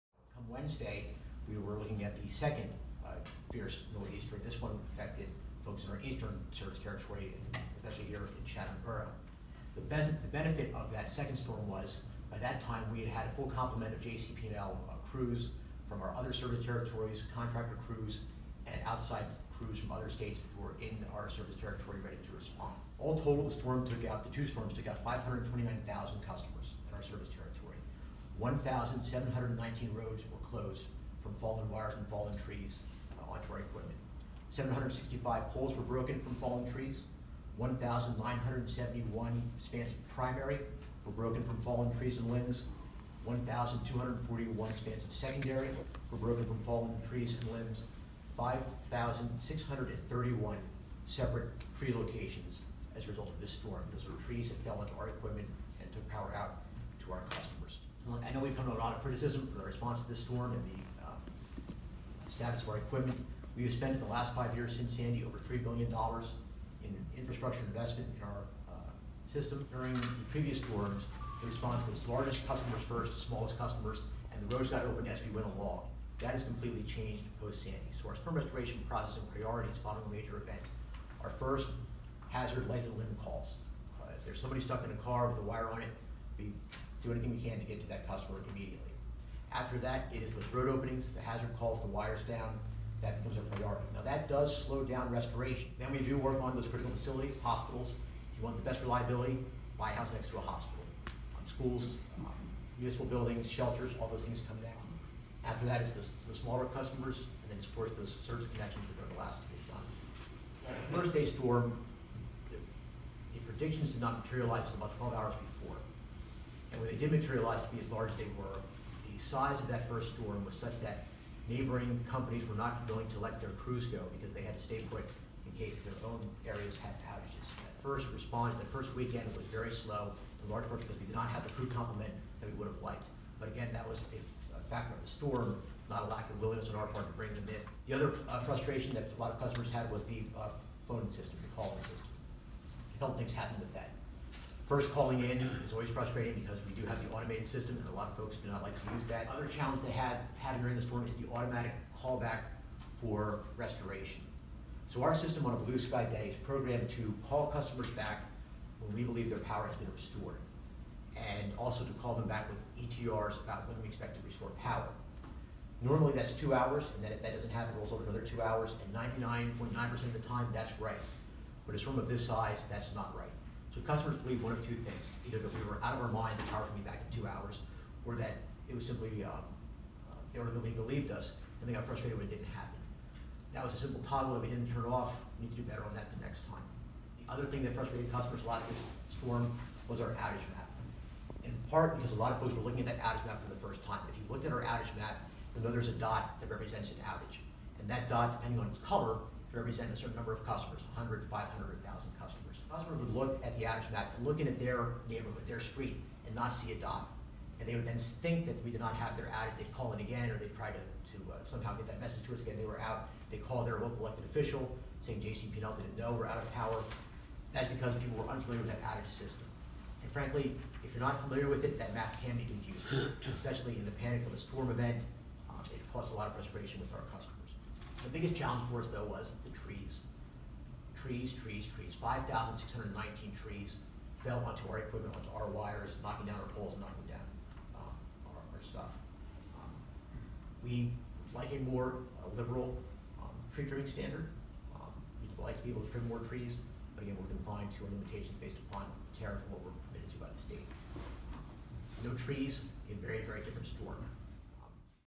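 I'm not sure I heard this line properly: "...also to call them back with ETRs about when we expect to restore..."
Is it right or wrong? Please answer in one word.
right.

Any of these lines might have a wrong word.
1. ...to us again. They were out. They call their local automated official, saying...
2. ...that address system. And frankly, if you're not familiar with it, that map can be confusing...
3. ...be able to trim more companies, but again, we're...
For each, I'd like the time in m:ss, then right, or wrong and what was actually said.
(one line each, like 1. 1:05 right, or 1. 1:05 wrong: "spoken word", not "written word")
1. 3:32 wrong: "elected", not "automated"
2. 3:38 right
3. 4:05 wrong: "trees", not "companies".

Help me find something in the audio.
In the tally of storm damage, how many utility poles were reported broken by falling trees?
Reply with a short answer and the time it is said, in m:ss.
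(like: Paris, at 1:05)
765, at 0:34.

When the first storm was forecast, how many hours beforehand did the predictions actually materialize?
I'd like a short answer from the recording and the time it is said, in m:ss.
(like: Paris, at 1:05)
12 hours, at 1:54.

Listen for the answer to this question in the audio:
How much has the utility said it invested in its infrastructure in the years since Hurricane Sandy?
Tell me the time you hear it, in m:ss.
1:05.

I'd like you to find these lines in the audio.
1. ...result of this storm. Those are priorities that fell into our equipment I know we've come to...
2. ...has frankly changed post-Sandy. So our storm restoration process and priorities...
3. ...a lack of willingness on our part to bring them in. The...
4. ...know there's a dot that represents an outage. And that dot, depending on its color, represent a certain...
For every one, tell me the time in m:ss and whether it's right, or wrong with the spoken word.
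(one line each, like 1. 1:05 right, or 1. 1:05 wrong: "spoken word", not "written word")
1. 0:53 wrong: "trees", not "priorities"
2. 1:16 wrong: "completely", not "frankly"
3. 2:16 right
4. 3:15 right.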